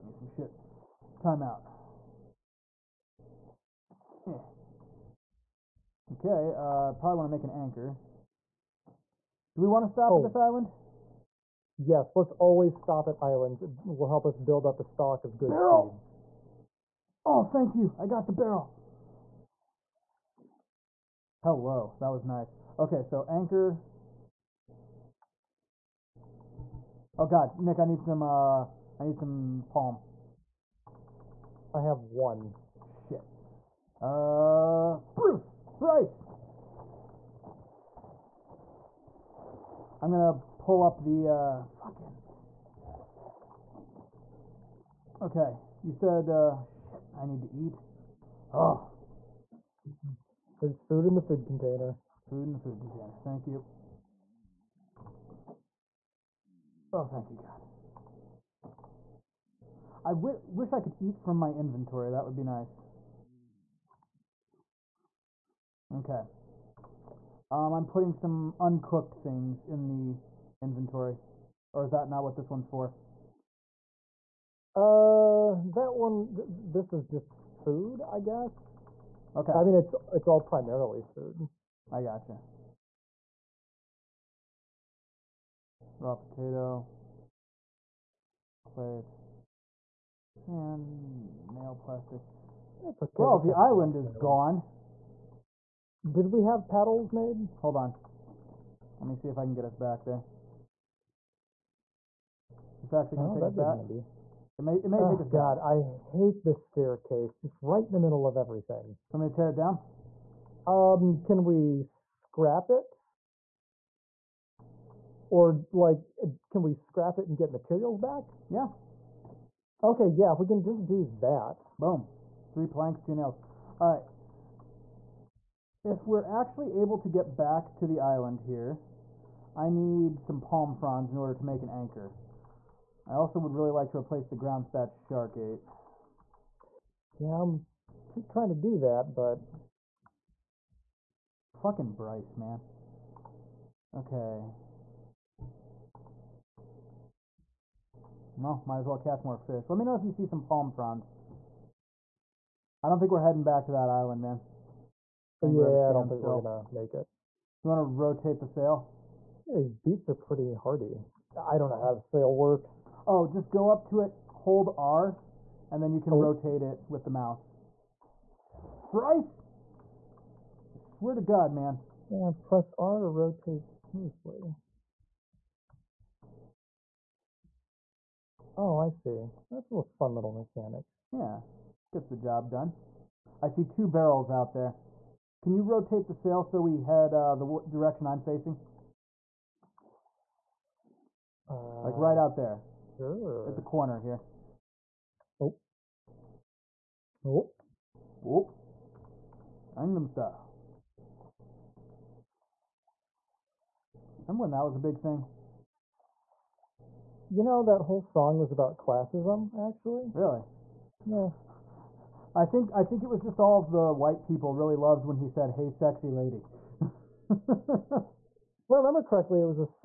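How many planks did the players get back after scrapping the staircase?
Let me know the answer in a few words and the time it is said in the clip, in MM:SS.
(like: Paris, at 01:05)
3, at 02:02.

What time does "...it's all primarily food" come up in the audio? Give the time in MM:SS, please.
01:20.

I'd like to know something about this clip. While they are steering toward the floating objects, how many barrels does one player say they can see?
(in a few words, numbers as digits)
2.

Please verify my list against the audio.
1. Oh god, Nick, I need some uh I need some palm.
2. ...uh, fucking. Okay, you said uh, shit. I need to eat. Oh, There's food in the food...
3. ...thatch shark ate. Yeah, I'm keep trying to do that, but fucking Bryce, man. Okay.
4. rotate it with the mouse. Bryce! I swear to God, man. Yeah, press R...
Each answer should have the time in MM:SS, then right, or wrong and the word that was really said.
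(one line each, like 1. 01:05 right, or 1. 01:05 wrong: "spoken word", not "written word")
1. 00:27 right
2. 00:41 right
3. 02:14 right
4. 02:46 right.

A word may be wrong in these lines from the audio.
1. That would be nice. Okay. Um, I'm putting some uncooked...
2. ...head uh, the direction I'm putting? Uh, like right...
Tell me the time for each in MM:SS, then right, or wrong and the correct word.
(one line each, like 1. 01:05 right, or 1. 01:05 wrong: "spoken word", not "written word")
1. 01:02 right
2. 03:06 wrong: "facing", not "putting".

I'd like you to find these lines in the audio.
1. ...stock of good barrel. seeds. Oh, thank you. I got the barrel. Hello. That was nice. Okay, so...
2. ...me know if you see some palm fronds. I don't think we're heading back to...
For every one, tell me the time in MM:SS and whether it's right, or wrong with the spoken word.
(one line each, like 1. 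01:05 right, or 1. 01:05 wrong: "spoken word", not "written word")
1. 00:14 right
2. 02:29 right.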